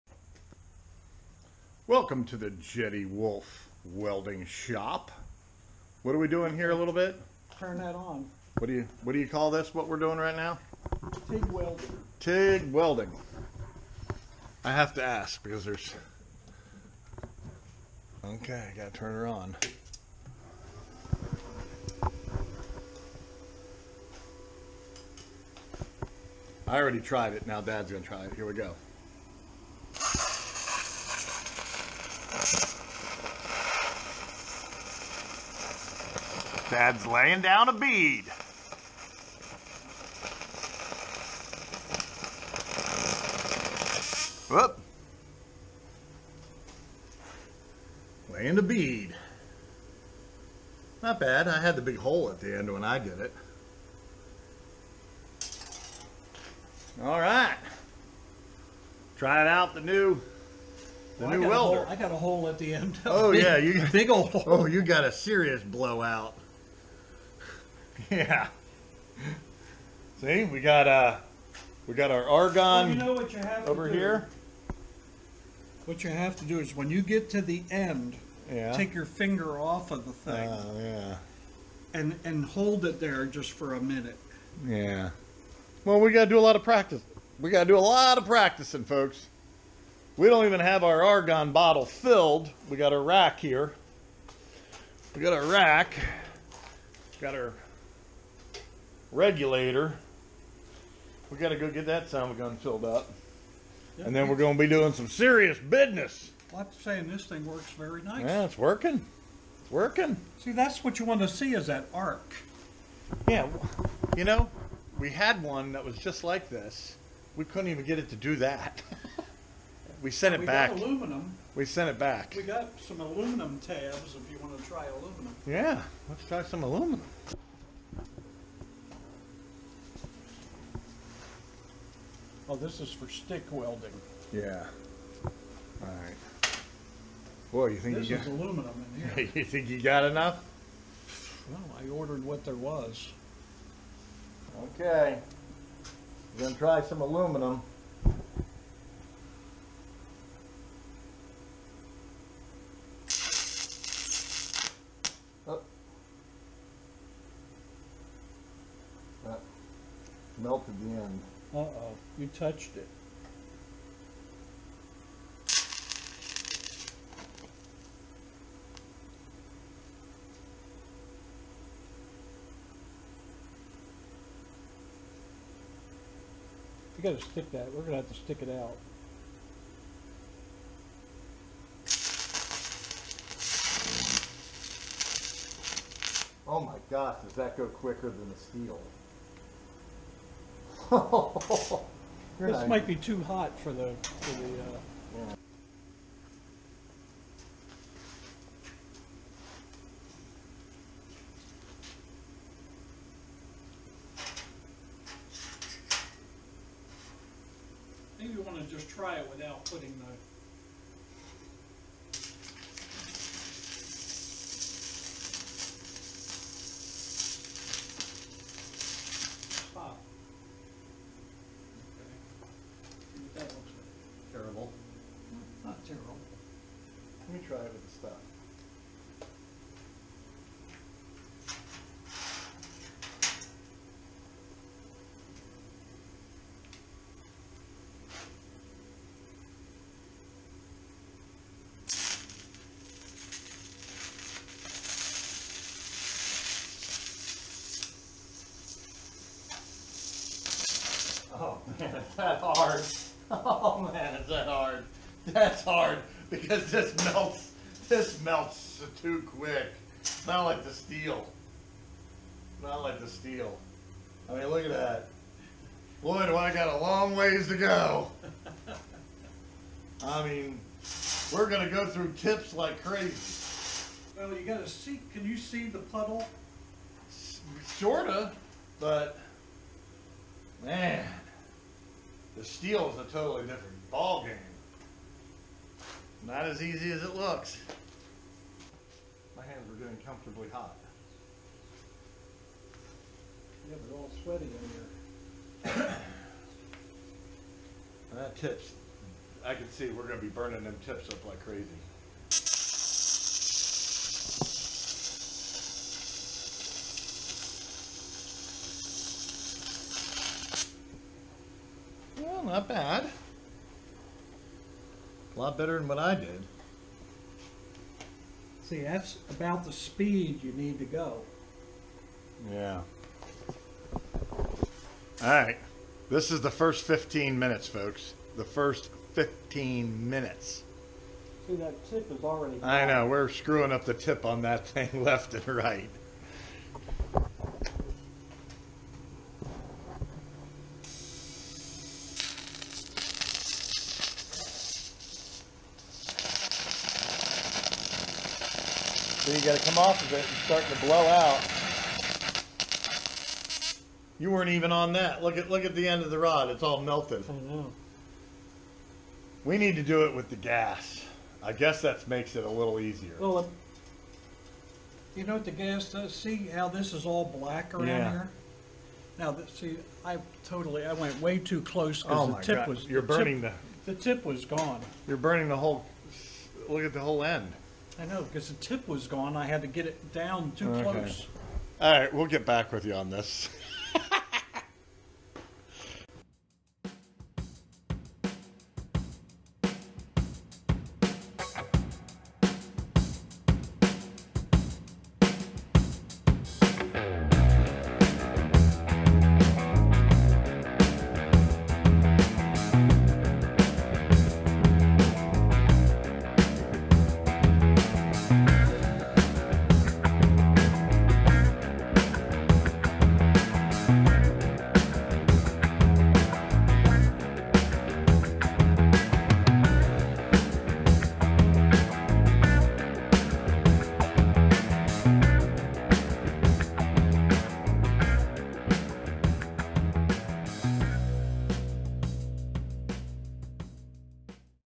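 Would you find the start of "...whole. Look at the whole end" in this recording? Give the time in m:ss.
6:15.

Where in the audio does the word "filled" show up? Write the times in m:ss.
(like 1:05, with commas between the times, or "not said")
1:31, 1:42.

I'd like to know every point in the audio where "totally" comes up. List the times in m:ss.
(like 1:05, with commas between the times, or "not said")
4:43, 6:10.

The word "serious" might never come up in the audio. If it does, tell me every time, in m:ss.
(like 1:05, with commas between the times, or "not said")
1:05, 1:45.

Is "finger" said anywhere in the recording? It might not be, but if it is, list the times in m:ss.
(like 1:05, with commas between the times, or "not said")
1:19.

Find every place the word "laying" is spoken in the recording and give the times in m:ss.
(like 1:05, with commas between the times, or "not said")
0:37, 0:48.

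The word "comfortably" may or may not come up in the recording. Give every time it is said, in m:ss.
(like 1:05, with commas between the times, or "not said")
4:50.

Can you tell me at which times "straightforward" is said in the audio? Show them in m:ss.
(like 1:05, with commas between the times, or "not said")
not said.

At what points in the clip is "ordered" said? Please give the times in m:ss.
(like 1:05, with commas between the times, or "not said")
2:21.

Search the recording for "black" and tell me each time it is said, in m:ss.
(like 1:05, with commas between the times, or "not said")
6:07.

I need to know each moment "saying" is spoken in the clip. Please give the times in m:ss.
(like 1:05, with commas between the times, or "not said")
1:46.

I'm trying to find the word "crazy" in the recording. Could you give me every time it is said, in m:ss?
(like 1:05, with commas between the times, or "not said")
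4:32, 5:01.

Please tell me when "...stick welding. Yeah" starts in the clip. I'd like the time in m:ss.
2:13.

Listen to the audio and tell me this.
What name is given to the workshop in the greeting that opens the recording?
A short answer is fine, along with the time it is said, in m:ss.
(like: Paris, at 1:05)
Jetty Wolf Welding Shop, at 0:02.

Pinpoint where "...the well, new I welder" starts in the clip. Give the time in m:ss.
1:01.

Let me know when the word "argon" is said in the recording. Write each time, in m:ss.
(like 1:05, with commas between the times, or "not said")
1:12, 1:31.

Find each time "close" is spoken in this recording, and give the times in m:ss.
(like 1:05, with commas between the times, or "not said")
6:11, 6:20.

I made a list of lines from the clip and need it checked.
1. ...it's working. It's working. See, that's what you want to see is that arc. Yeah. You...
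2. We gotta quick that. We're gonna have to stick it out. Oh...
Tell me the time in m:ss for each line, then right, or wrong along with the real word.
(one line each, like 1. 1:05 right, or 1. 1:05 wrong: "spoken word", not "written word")
1. 1:48 right
2. 2:56 wrong: "stick", not "quick".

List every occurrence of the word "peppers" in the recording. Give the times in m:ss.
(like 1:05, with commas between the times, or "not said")
not said.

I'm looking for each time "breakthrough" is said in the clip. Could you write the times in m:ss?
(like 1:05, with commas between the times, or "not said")
not said.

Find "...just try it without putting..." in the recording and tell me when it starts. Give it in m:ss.
3:28.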